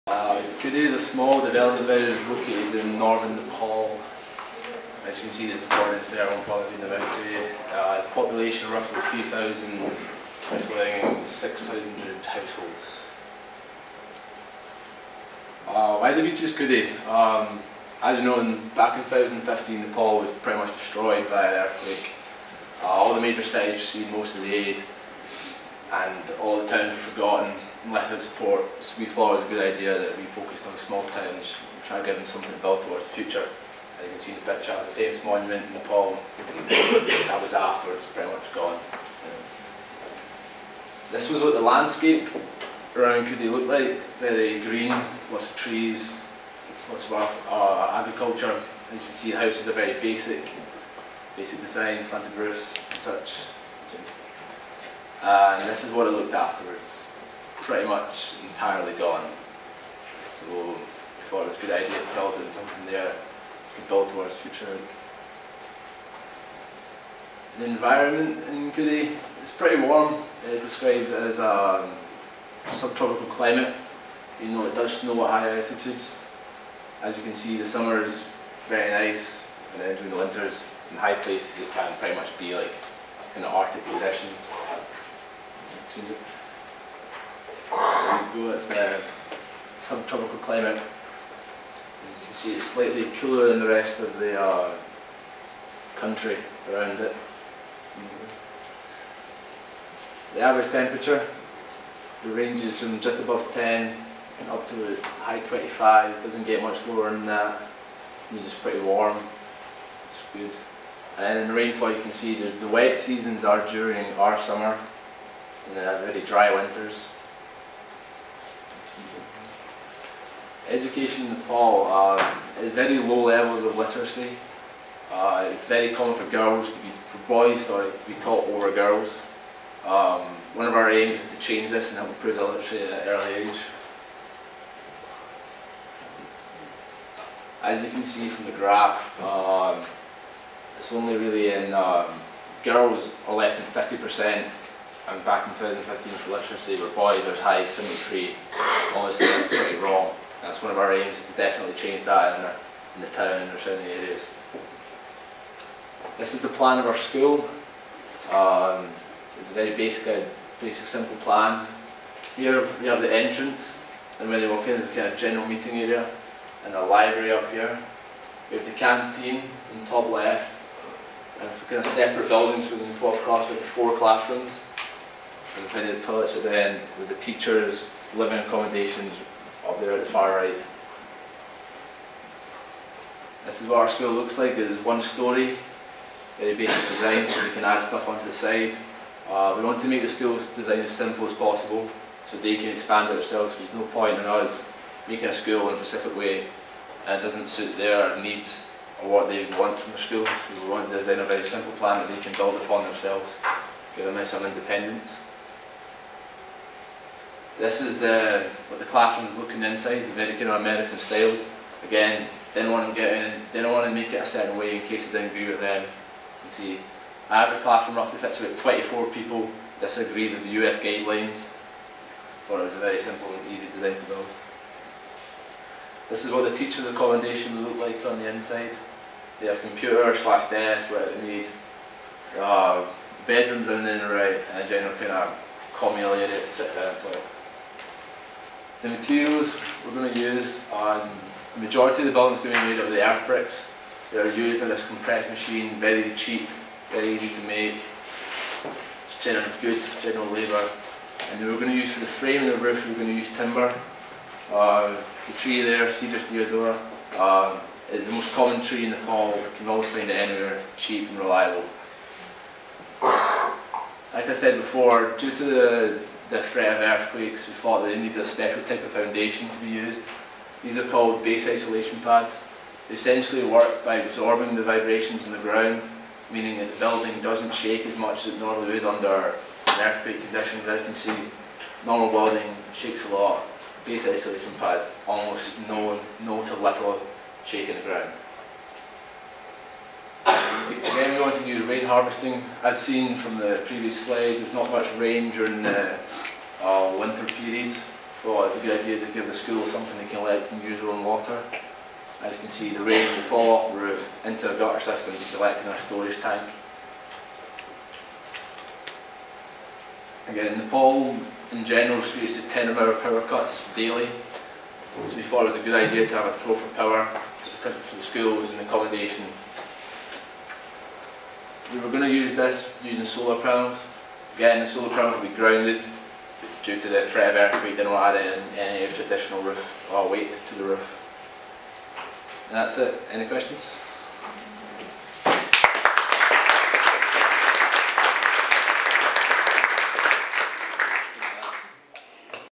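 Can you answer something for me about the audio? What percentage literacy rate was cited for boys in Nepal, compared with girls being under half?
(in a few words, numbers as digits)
73%.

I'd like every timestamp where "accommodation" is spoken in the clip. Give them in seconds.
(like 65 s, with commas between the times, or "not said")
178 s, 226 s, 318 s.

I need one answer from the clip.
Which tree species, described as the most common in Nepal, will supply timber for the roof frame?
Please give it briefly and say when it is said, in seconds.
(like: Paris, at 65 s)
Cedrus deodara, at 255 s.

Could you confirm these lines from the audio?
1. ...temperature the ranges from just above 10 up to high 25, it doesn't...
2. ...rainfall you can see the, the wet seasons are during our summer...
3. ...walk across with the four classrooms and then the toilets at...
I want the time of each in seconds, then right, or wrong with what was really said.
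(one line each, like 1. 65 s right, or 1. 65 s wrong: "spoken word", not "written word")
1. 100 s right
2. 111 s right
3. 173 s right.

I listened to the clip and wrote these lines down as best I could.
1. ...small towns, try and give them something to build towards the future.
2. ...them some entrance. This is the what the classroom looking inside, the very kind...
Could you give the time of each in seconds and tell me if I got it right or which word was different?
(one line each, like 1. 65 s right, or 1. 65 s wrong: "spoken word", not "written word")
1. 30 s right
2. 204 s wrong: "independence", not "entrance".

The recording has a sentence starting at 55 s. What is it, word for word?
and this is what it looked afterwards pretty much entirely gone.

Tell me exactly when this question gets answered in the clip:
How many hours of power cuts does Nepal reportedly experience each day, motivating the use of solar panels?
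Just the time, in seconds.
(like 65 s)
312 s.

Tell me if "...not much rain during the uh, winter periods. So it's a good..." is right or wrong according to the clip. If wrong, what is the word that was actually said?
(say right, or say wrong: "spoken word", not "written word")
right.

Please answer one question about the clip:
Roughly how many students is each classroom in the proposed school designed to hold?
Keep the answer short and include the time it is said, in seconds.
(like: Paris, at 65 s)
24, at 218 s.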